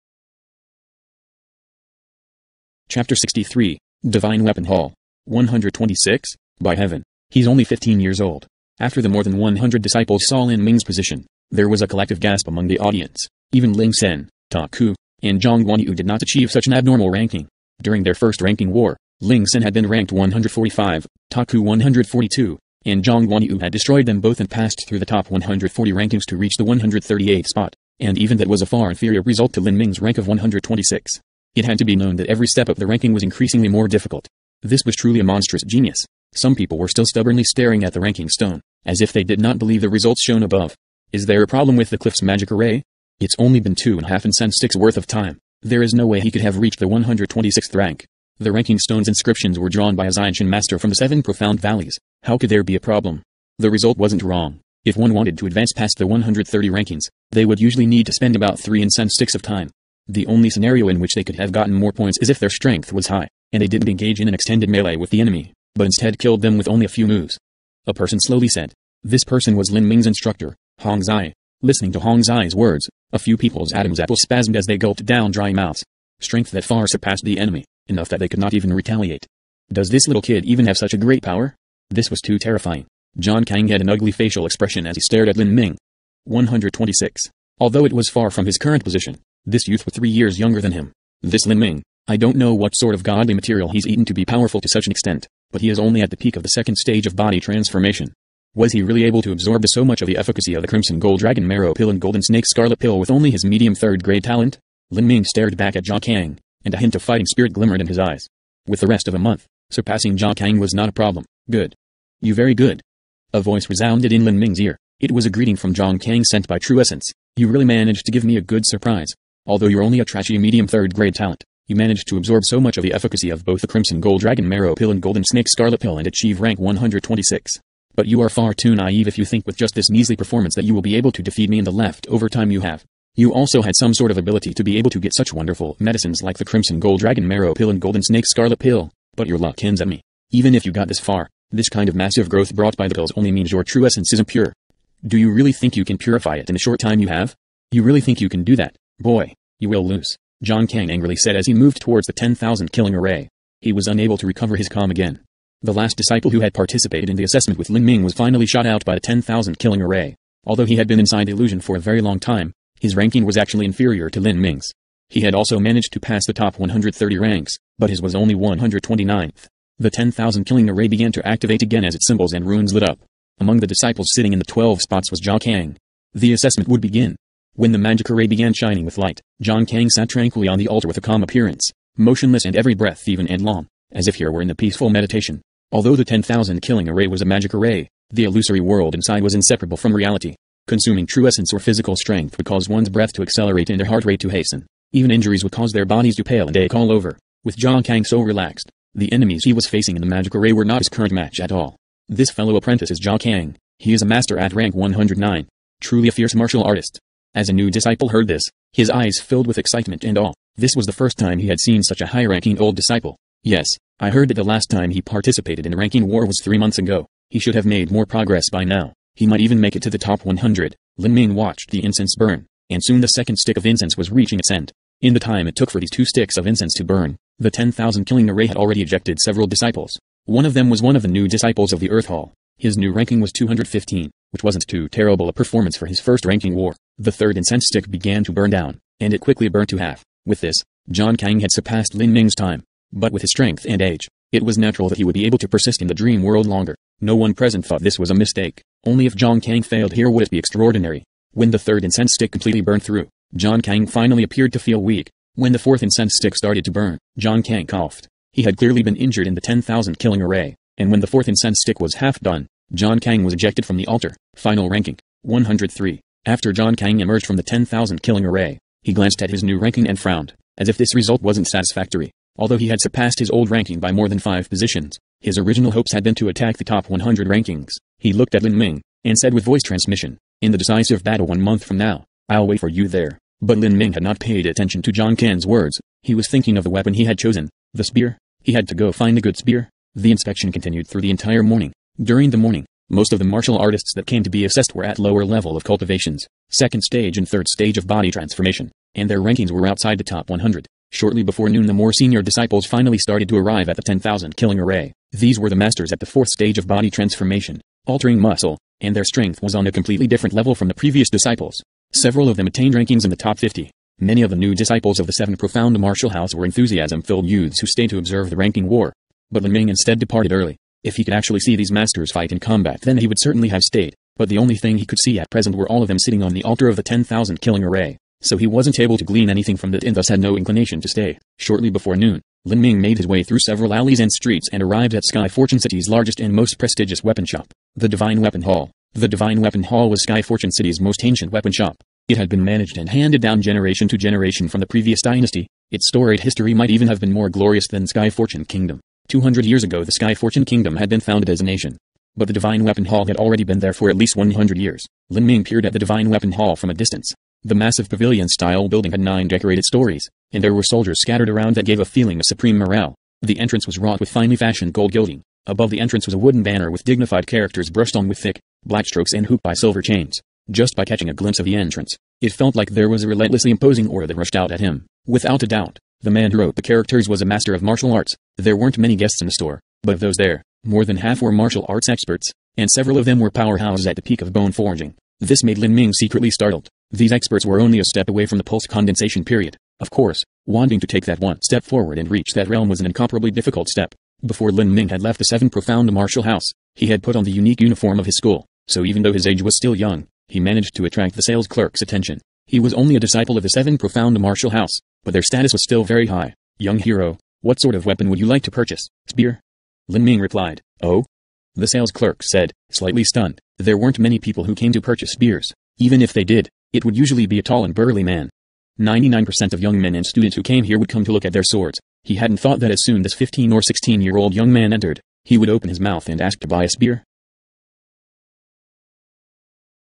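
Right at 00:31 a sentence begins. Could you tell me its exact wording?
It had to be known that every step up the ranking was increasingly more difficult.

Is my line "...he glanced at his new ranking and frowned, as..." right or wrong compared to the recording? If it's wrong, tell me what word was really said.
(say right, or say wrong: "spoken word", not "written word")
right.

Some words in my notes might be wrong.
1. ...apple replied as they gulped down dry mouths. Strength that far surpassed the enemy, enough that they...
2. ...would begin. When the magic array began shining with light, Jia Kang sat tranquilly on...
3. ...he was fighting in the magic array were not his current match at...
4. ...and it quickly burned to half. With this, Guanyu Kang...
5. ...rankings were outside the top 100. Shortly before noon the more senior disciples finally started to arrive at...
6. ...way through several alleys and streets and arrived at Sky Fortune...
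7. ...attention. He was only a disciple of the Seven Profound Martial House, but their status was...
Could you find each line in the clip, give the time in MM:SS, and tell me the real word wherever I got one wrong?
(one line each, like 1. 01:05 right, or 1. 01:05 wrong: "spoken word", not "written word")
1. 01:13 wrong: "spasmed", not "replied"
2. 02:56 right
3. 03:19 wrong: "facing", not "fighting"
4. 03:58 wrong: "Jia", not "Guanyu"
5. 04:59 right
6. 05:33 right
7. 06:41 right.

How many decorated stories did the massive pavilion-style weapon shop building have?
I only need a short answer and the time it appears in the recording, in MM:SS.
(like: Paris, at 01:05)
9, at 05:59.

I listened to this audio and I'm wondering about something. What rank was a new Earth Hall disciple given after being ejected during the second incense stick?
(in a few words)
215.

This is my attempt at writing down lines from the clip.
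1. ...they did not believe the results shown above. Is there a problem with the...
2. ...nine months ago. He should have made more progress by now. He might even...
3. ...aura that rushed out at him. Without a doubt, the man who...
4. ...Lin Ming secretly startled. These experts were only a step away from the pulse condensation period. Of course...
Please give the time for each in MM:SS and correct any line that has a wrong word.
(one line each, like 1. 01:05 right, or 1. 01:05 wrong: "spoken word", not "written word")
1. 00:39 right
2. 03:36 wrong: "three", not "nine"
3. 06:13 right
4. 06:25 right.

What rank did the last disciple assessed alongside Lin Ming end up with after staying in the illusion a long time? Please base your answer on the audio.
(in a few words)
129.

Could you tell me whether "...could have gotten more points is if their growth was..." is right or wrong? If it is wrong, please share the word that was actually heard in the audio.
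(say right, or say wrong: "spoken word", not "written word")
wrong: "strength", not "growth".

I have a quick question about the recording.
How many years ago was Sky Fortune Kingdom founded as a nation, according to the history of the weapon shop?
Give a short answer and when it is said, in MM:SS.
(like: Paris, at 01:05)
200, at 05:49.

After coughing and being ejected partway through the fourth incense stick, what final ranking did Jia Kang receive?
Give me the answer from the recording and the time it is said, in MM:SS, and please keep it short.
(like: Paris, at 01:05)
103, at 04:25.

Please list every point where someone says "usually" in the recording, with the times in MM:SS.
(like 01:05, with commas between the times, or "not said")
00:57, 06:56.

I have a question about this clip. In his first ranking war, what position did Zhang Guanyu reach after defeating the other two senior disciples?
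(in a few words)
138.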